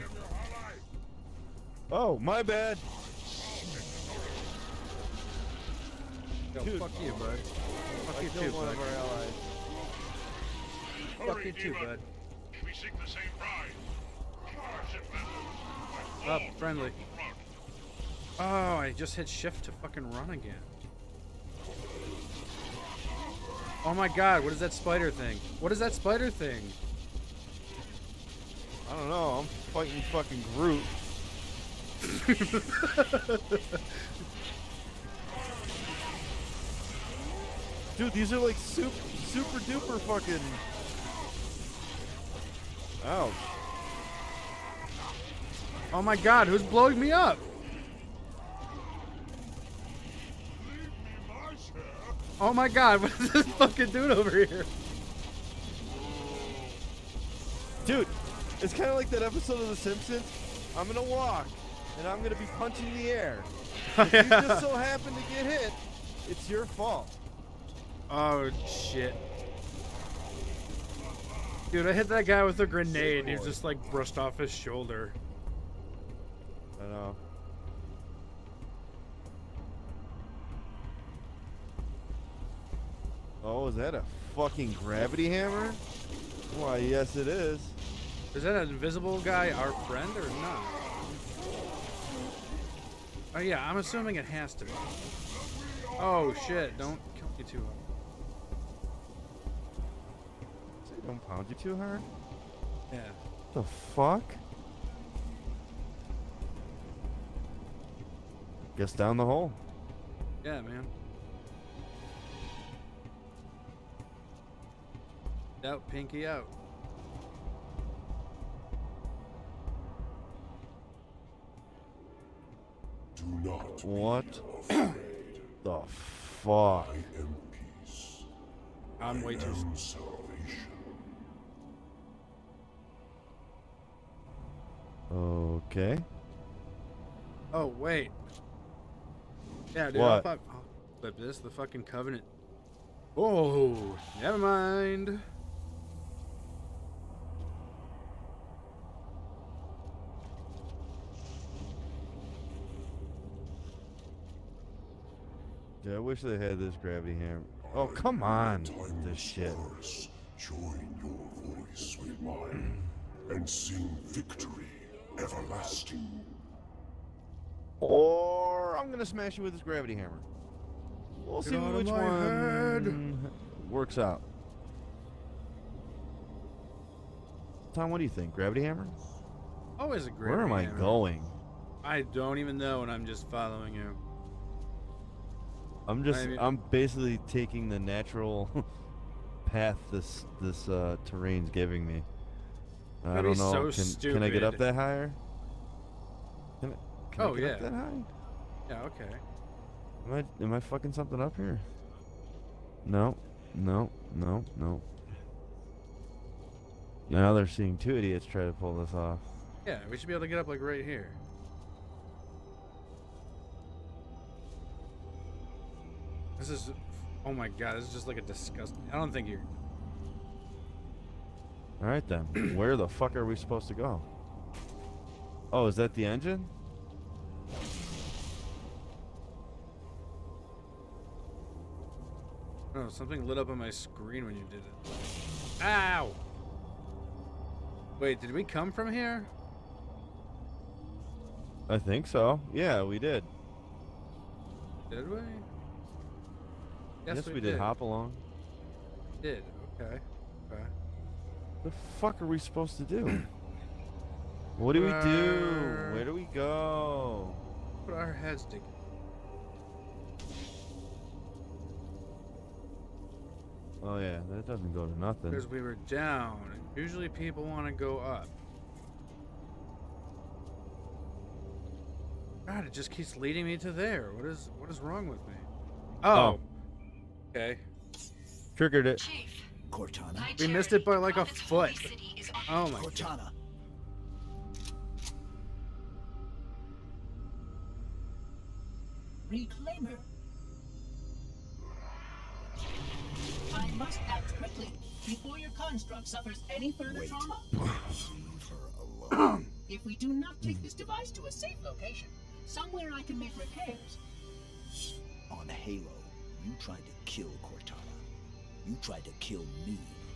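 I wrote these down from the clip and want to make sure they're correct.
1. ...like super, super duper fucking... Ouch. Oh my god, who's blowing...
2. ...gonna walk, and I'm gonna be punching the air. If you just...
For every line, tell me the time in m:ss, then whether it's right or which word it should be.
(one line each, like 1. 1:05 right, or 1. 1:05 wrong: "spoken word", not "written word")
1. 0:38 right
2. 1:00 right.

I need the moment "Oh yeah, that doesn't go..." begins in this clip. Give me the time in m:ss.
4:23.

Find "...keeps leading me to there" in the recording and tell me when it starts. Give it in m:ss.
4:32.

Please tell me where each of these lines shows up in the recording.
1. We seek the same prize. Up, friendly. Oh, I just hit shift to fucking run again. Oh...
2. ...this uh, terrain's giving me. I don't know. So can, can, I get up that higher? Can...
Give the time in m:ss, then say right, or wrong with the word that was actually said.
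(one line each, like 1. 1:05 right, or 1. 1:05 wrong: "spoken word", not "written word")
1. 0:12 right
2. 3:10 right.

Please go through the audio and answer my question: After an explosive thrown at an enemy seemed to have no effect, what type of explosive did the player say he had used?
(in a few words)
A grenade.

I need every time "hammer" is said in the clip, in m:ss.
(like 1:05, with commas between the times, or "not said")
1:25, 2:37, 2:49, 2:58.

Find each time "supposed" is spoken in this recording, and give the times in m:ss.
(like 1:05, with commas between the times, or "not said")
3:43, 4:12.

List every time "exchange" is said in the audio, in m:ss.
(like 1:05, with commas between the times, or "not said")
not said.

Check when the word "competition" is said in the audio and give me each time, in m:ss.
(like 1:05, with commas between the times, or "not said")
not said.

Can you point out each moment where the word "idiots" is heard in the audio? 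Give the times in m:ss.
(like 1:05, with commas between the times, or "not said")
3:27.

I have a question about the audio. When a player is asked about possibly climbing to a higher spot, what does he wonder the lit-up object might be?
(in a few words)
The engine.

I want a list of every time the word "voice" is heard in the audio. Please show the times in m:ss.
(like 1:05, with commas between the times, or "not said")
2:41.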